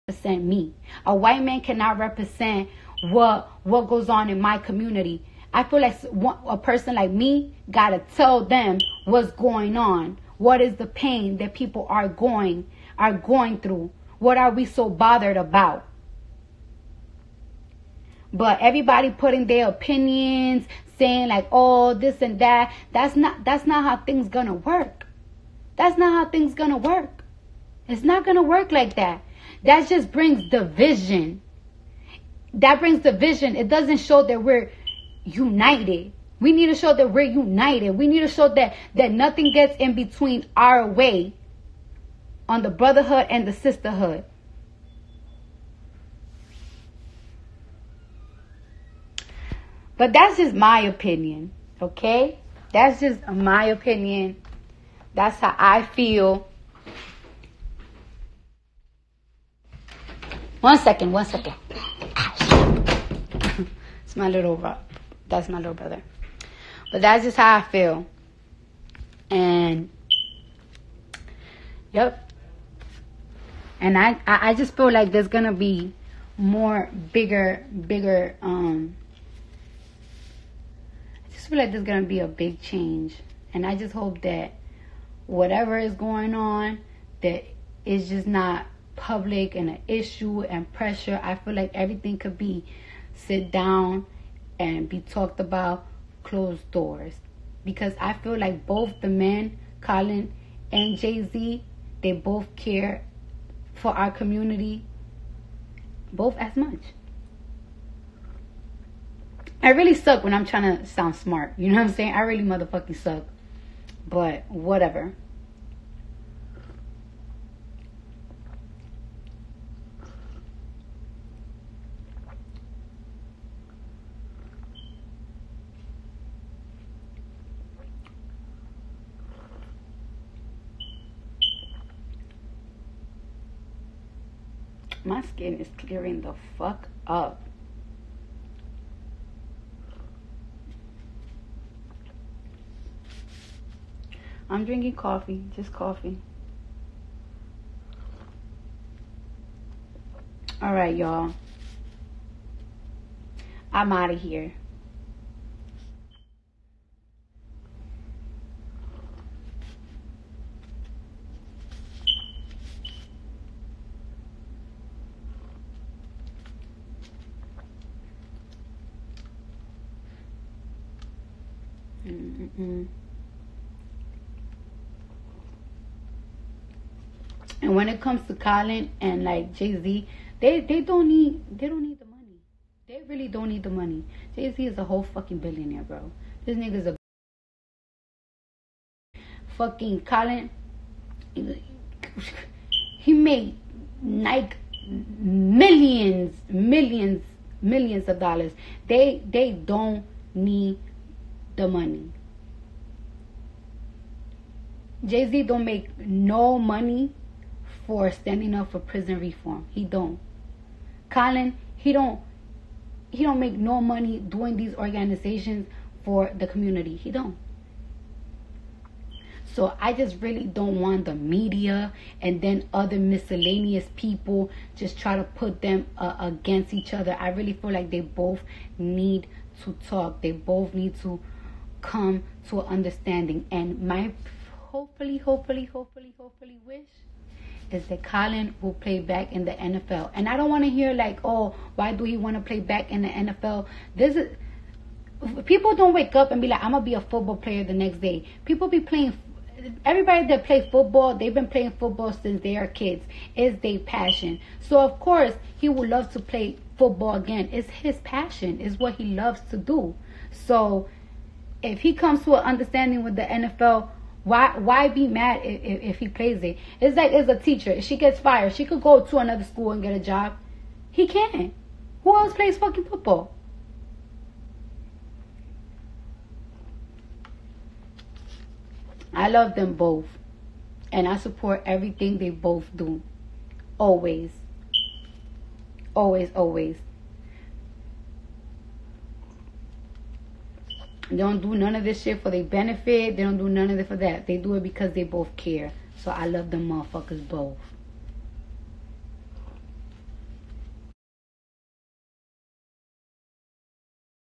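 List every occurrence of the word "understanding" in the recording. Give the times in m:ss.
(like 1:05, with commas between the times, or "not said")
3:52, 4:22.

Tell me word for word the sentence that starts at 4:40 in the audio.
And I support everything they both do.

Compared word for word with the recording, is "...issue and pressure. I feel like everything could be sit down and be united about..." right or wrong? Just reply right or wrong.
wrong.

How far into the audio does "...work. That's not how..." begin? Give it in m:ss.
0:24.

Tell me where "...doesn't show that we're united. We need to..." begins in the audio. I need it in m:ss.
0:33.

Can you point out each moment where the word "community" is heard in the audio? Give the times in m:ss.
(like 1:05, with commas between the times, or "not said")
0:04, 1:44, 3:36.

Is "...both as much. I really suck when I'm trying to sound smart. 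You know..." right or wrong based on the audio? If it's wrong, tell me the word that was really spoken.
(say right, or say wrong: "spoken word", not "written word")
right.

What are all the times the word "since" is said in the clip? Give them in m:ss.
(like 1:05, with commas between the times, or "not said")
4:12.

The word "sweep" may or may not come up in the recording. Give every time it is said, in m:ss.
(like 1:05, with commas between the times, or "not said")
not said.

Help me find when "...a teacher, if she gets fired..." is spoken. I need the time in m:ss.
4:27.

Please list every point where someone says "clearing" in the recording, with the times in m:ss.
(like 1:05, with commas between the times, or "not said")
2:15.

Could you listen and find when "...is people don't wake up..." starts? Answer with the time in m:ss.
4:04.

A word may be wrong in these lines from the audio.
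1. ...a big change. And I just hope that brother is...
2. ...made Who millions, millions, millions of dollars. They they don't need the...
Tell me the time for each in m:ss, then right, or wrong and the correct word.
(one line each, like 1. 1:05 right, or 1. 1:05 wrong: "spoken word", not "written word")
1. 1:22 wrong: "whatever", not "brother"
2. 3:13 wrong: "Nike", not "Who".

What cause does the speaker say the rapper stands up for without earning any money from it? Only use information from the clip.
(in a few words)
prison reform.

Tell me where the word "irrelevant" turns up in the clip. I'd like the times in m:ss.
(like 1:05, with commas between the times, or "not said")
not said.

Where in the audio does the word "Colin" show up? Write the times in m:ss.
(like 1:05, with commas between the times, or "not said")
1:39, 2:58, 3:10, 3:31, 3:58.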